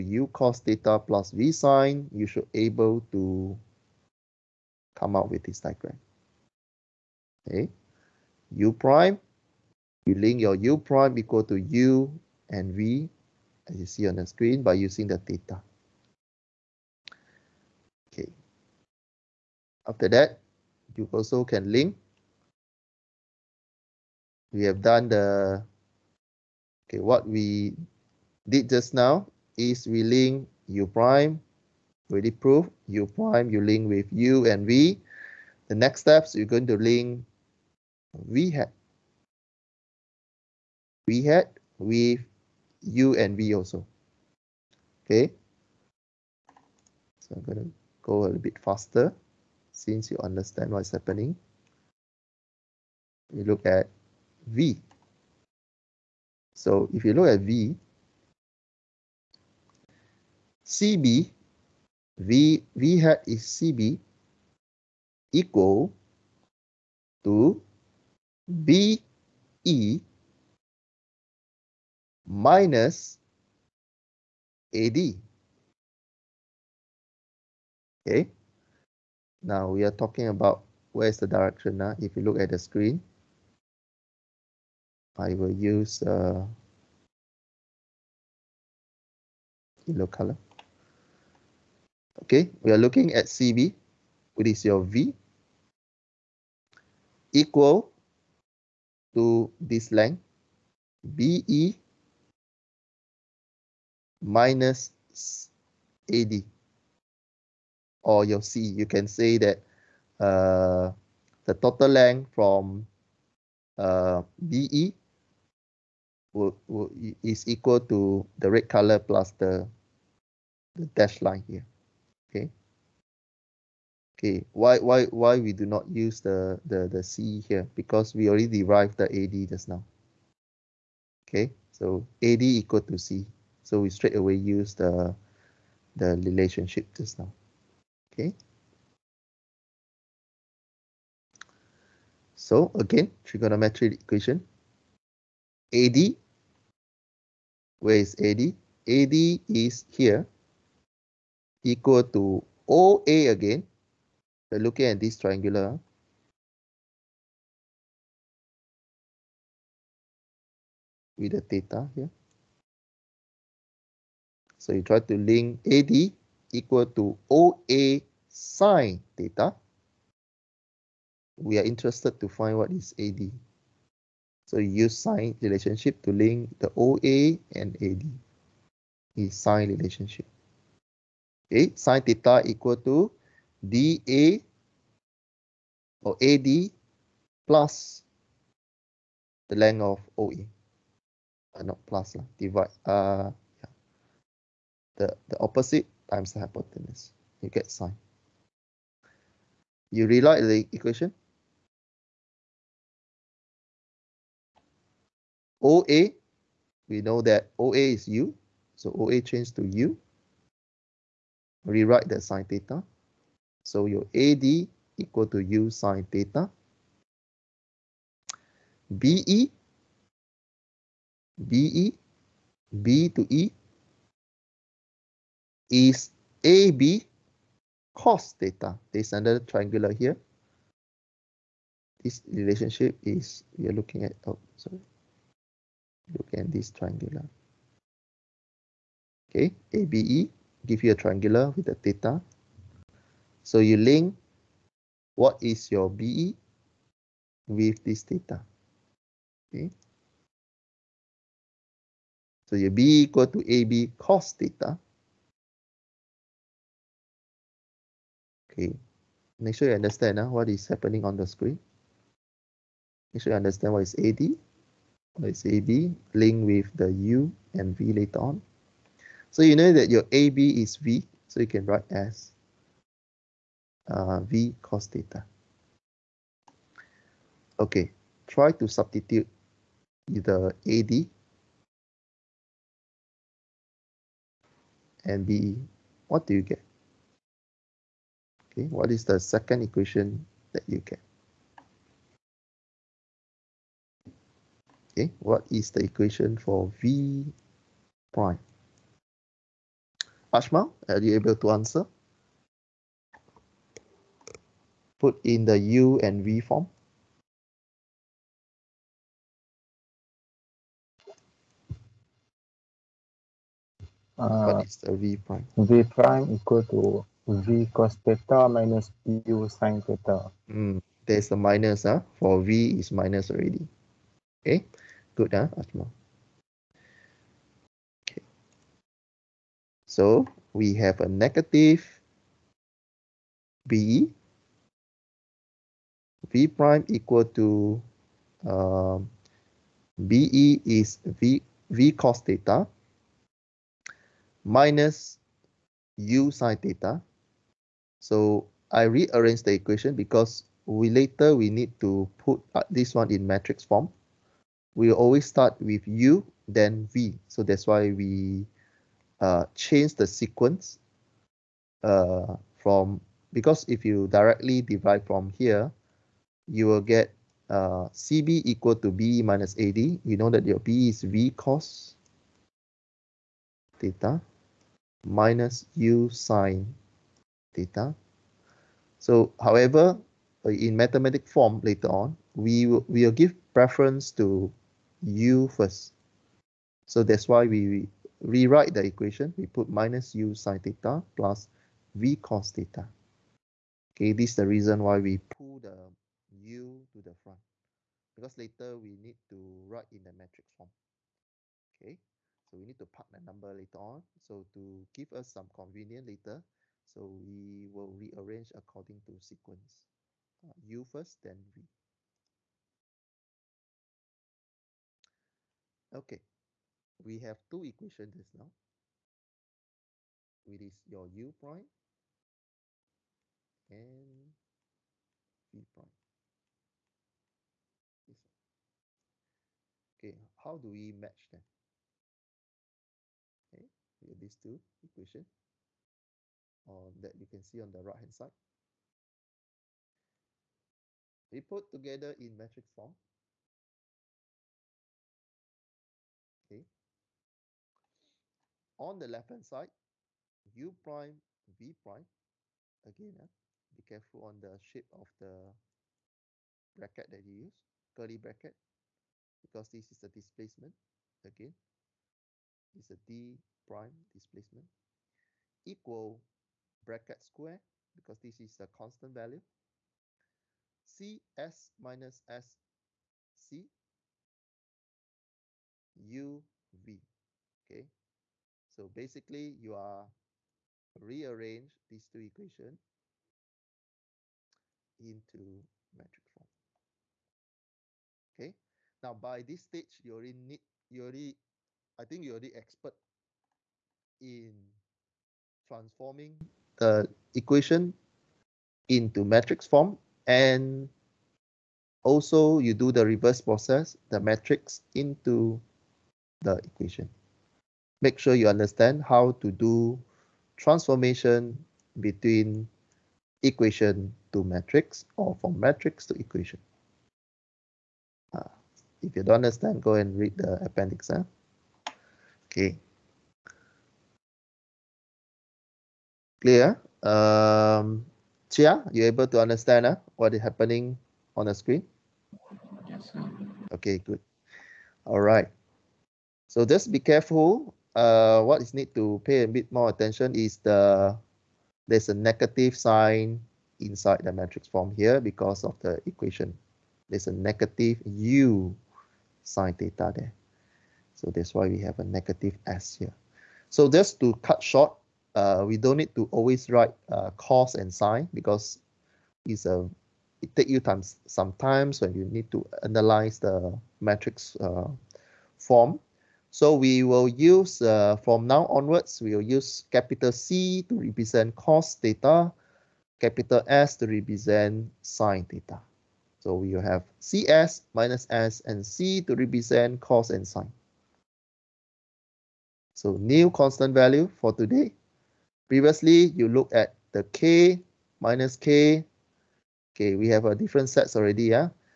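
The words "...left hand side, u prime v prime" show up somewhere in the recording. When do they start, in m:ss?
7:29.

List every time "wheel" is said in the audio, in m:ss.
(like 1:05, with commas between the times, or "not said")
not said.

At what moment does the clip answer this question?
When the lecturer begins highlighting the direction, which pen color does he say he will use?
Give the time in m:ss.
1:29.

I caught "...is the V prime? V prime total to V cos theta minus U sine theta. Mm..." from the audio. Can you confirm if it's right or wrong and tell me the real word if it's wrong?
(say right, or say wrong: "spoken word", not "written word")
wrong: "equal", not "total".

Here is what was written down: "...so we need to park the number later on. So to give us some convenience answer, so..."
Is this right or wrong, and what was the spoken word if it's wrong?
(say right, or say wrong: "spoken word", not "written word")
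wrong: "later", not "answer".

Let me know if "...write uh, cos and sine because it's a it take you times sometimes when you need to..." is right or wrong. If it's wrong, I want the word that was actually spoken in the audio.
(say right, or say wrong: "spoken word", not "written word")
right.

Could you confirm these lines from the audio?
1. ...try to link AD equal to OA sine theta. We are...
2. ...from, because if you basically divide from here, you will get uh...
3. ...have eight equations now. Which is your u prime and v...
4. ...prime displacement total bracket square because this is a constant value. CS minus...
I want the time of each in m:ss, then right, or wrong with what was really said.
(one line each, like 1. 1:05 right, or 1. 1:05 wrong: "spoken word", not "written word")
1. 2:44 right
2. 6:02 wrong: "directly", not "basically"
3. 6:57 wrong: "two", not "eight"
4. 7:43 wrong: "equal", not "total".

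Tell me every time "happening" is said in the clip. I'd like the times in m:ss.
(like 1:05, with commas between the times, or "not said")
0:50, 4:20, 8:50.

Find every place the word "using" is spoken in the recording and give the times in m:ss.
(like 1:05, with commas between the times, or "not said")
0:14.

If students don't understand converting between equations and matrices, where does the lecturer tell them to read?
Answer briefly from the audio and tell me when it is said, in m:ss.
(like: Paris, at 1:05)
The appendix, at 8:40.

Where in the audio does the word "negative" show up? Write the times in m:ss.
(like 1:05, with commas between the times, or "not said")
5:31, 9:02, 9:07, 9:12.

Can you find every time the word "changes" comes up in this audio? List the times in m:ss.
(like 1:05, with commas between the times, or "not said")
3:29, 5:59.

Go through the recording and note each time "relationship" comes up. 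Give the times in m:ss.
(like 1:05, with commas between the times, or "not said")
2:16, 2:55, 2:59, 3:52.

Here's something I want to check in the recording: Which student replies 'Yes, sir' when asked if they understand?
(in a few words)
Chia.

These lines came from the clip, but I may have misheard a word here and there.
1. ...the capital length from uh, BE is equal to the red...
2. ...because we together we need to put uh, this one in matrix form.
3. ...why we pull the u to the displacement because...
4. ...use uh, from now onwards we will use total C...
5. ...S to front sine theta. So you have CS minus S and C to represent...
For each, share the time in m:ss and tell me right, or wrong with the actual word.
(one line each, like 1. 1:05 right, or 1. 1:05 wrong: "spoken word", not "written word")
1. 1:51 wrong: "total", not "capital"
2. 5:49 wrong: "later", not "together"
3. 6:34 wrong: "front", not "displacement"
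4. 9:27 wrong: "capital", not "total"
5. 9:33 wrong: "represent", not "front".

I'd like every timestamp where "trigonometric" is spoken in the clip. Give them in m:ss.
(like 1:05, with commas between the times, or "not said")
2:23.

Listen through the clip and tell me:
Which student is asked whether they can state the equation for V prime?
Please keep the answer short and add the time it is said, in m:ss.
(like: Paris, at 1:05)
Ashma, at 5:00.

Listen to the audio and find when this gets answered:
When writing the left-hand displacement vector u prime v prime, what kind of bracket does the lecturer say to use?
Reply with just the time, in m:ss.
7:37.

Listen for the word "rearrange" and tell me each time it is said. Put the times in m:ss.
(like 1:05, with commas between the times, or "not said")
5:48, 6:47, 8:00.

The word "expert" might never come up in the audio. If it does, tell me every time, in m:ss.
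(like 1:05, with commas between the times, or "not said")
8:12.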